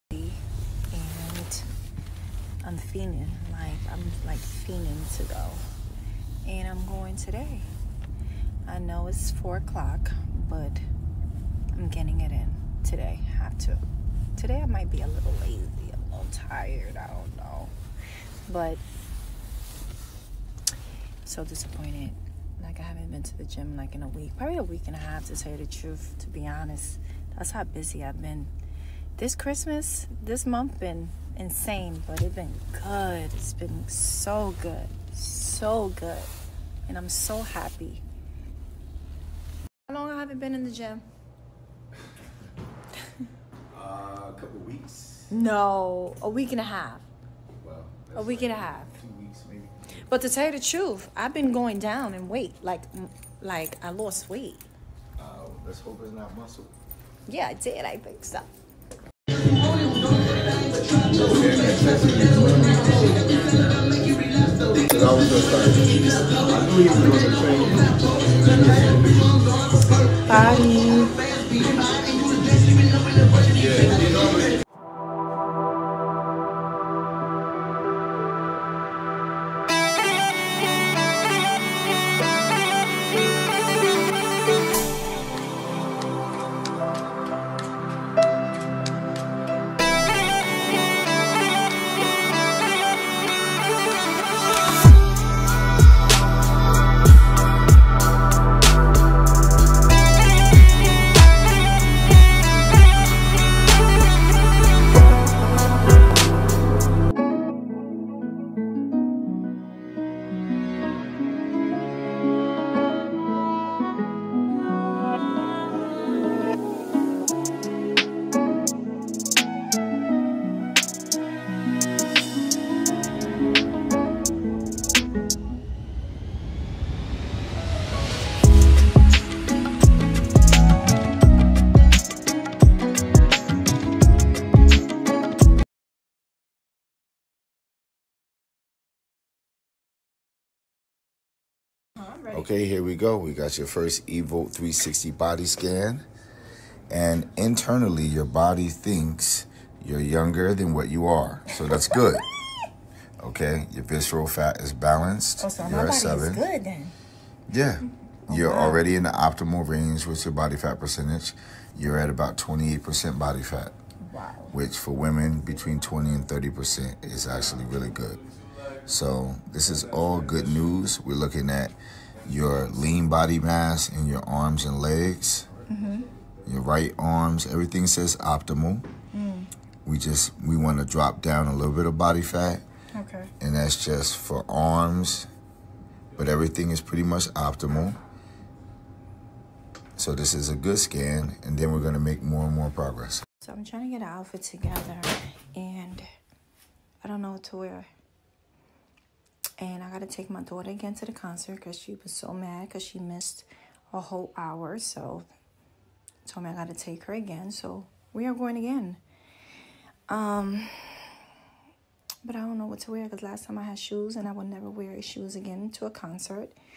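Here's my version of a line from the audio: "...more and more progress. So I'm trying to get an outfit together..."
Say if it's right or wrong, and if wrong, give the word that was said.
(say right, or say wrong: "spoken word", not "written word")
right.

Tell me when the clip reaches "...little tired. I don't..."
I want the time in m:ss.
0:16.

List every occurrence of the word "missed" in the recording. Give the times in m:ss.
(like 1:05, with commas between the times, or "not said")
3:22.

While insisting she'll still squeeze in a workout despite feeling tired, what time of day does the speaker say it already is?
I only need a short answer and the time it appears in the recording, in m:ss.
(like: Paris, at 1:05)
4 o'clock, at 0:09.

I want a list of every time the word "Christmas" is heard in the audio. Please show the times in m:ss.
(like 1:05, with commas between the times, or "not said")
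0:29.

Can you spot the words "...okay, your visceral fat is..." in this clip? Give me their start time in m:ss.
2:33.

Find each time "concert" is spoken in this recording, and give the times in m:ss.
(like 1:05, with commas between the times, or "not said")
3:21, 3:35.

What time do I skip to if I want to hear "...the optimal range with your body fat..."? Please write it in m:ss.
2:39.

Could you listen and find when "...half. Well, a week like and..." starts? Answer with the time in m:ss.
0:46.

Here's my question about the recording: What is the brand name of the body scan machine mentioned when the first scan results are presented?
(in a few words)
Evolt 360.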